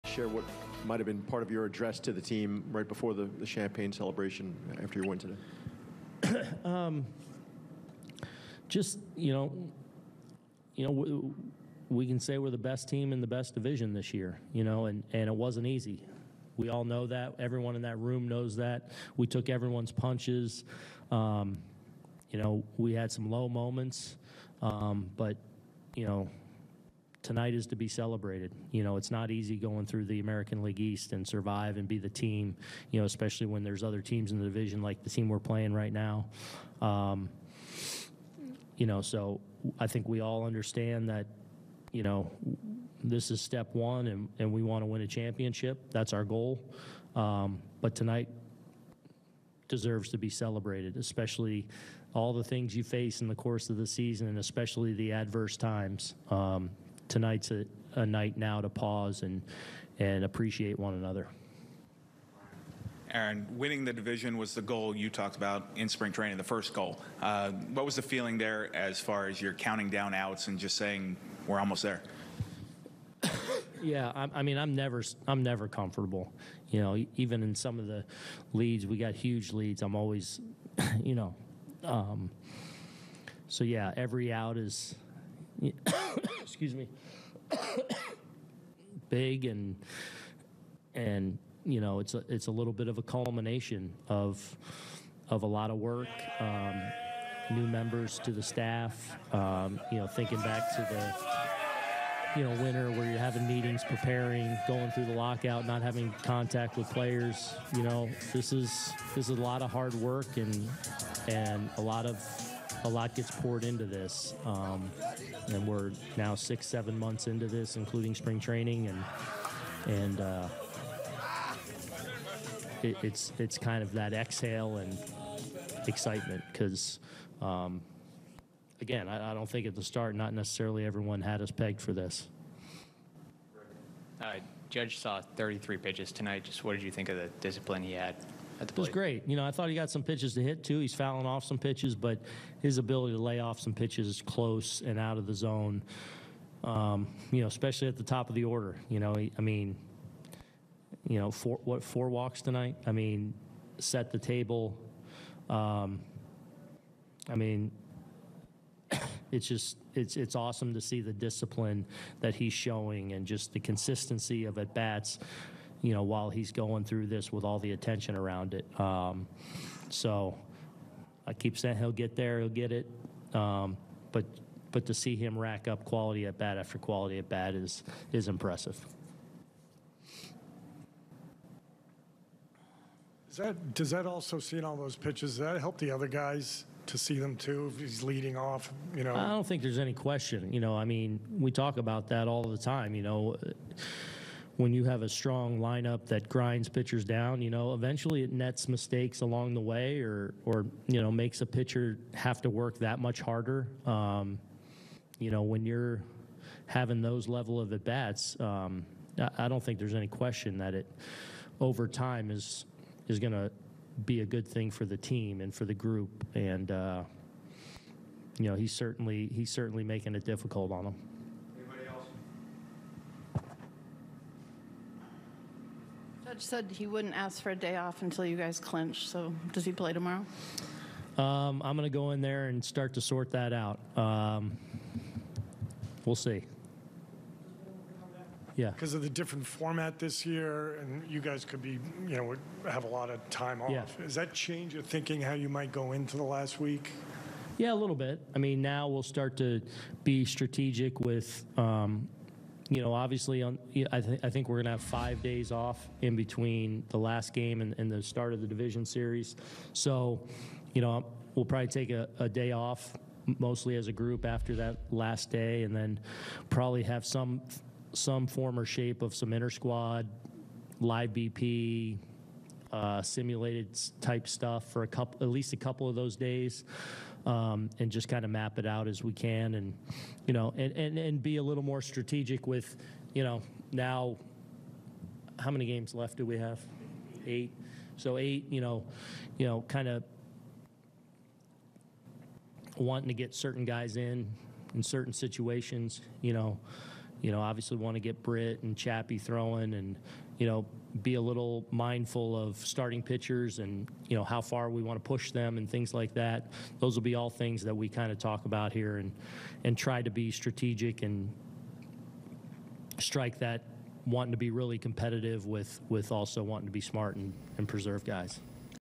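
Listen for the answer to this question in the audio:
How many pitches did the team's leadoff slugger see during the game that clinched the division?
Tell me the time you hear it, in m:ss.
2:15.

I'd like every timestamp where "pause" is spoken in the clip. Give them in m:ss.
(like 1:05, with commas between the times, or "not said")
0:58.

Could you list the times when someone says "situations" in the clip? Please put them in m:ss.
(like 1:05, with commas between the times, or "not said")
4:55.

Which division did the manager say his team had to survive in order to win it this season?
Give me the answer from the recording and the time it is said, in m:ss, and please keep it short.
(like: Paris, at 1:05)
American League East, at 0:30.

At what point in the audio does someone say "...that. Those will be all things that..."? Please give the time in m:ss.
5:06.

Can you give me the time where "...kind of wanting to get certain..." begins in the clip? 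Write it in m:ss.
4:49.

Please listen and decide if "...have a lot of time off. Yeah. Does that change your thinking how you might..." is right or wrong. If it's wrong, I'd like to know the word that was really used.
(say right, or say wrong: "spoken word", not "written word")
right.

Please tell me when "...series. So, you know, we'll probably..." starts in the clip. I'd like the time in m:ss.
4:18.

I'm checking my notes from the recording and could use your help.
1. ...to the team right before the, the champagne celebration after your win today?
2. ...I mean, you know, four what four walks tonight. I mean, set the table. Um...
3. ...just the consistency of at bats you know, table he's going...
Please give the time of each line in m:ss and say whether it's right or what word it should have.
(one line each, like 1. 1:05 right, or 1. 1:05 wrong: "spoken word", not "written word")
1. 0:02 right
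2. 2:29 right
3. 2:43 wrong: "while", not "table".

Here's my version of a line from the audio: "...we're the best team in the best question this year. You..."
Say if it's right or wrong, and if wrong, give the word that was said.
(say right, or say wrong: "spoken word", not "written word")
wrong: "division", not "question".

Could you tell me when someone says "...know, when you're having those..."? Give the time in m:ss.
3:25.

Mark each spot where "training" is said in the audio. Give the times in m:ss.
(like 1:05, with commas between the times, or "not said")
1:06, 1:58.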